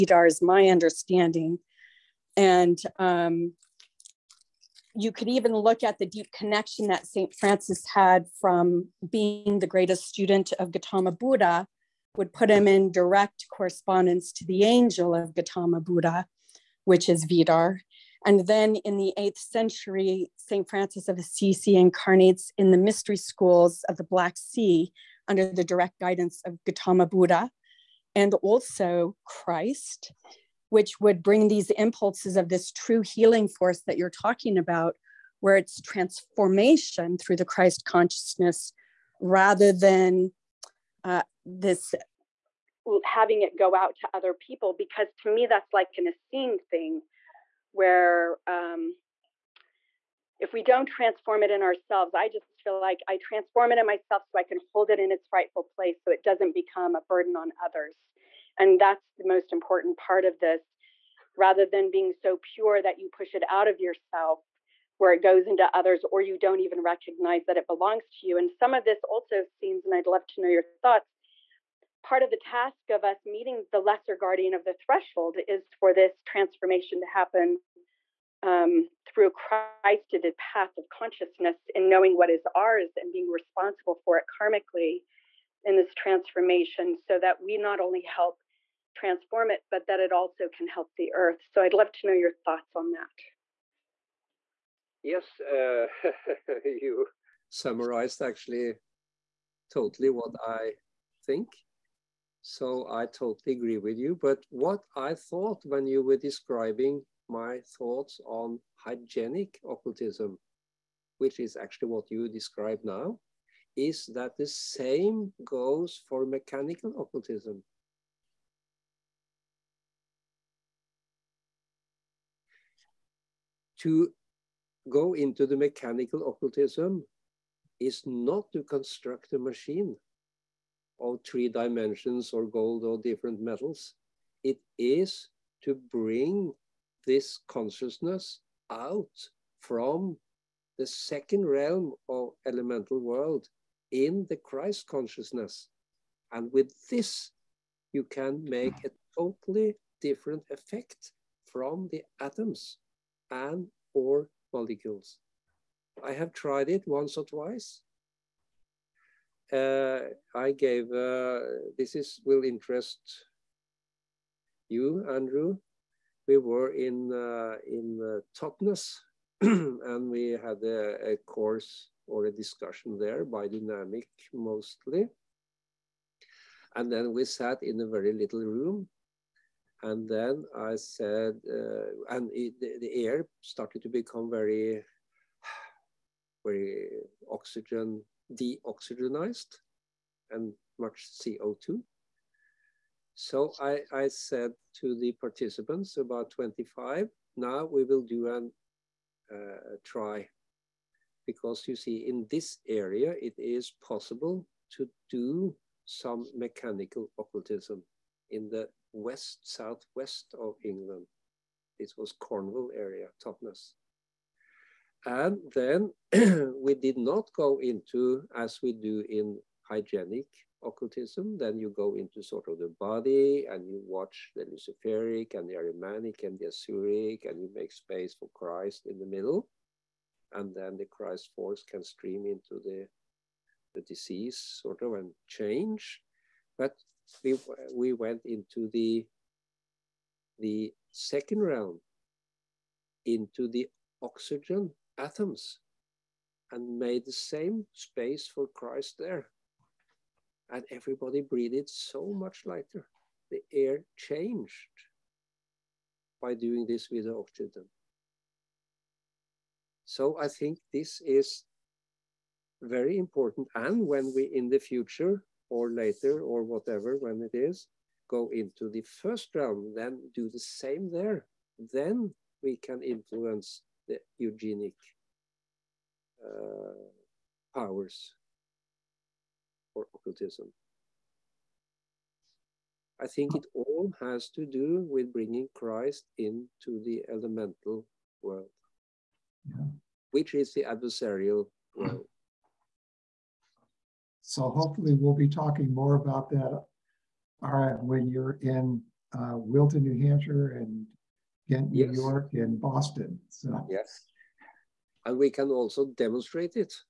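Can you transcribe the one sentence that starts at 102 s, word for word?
So I totally agree with you.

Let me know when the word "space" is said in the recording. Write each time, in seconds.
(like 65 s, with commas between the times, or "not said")
227 s, 247 s.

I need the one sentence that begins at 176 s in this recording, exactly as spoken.
And then we sat in a very little room.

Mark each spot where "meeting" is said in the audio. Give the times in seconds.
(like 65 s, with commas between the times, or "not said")
73 s.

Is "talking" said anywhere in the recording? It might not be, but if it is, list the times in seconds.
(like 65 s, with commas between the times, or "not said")
34 s, 295 s.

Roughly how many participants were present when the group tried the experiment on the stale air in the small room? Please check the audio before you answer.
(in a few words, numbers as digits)
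25.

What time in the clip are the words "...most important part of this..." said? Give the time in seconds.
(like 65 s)
59 s.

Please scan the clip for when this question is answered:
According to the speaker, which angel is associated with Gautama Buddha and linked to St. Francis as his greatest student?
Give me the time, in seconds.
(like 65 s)
17 s.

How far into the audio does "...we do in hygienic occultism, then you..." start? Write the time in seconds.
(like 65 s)
218 s.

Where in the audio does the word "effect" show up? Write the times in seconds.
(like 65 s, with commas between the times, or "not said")
150 s.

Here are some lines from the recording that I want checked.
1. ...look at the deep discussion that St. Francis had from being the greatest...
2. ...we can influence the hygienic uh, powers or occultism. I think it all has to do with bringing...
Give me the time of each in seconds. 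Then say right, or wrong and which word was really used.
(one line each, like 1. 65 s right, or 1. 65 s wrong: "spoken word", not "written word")
1. 5 s wrong: "connection", not "discussion"
2. 272 s wrong: "eugenic", not "hygienic".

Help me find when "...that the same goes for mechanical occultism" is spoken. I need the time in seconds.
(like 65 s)
114 s.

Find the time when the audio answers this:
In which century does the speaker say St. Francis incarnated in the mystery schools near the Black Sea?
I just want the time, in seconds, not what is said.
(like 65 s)
19 s.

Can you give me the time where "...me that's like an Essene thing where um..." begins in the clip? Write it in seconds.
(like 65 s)
45 s.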